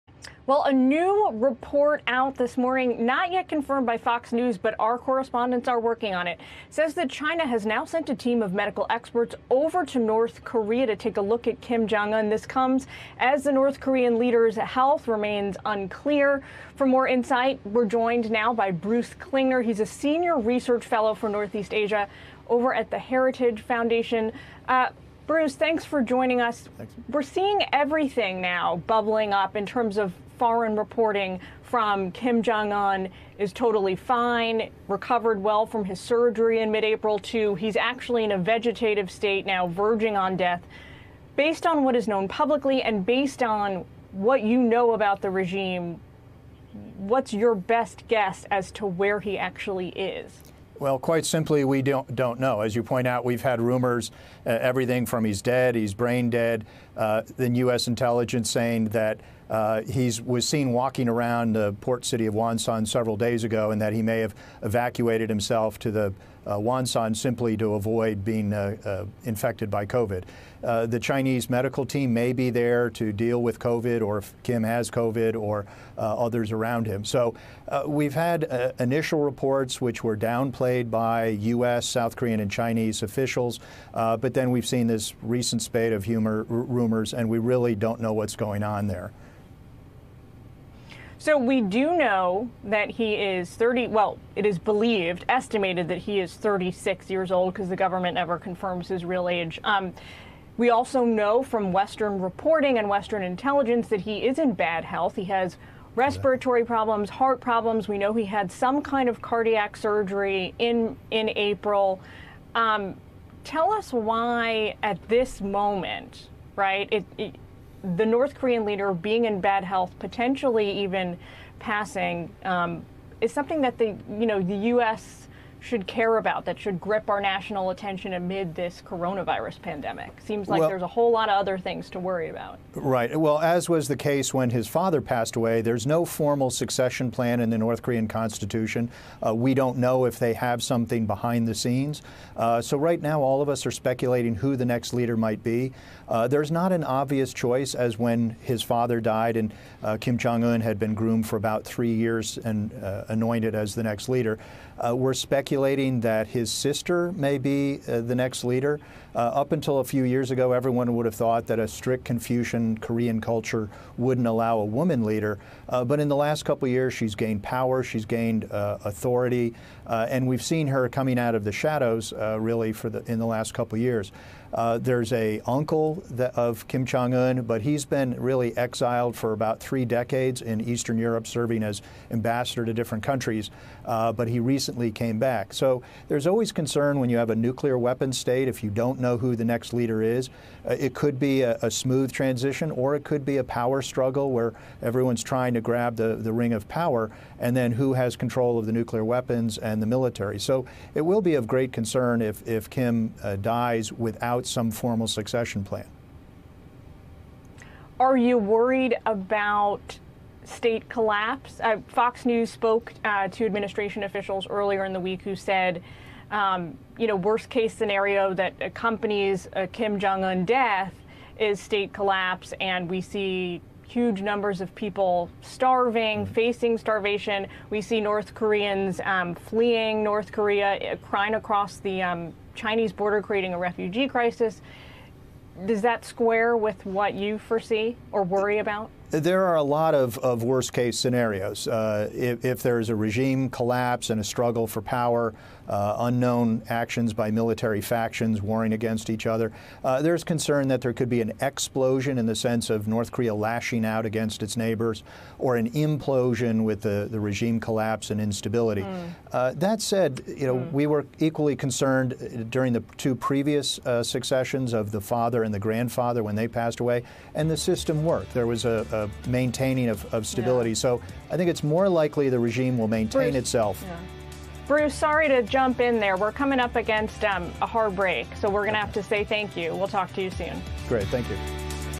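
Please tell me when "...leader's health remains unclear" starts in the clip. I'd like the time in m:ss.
0:14.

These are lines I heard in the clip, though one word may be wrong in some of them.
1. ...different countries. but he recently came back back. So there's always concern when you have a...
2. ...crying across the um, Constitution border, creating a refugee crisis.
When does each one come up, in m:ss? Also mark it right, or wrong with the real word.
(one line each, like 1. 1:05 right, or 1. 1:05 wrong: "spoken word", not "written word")
1. 3:02 right
2. 3:51 wrong: "Chinese", not "Constitution".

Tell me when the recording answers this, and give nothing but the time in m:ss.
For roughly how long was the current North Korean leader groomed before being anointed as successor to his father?
2:31.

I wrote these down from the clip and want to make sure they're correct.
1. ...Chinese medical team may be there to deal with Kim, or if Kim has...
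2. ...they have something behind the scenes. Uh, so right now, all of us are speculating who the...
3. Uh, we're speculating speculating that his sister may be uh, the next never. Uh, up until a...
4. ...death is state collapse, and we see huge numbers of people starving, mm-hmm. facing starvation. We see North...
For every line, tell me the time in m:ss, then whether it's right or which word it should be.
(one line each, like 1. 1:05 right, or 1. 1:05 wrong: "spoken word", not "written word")
1. 1:11 wrong: "COVID", not "Kim"
2. 2:20 right
3. 2:34 wrong: "leader", not "never"
4. 3:40 right.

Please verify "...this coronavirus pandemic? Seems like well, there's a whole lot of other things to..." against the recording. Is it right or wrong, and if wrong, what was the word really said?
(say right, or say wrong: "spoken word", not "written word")
right.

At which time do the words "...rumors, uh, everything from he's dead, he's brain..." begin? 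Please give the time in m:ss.
0:53.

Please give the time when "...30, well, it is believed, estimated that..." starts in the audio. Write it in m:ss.
1:33.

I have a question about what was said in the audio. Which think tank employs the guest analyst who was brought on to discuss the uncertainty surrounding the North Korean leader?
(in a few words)
Heritage Foundation.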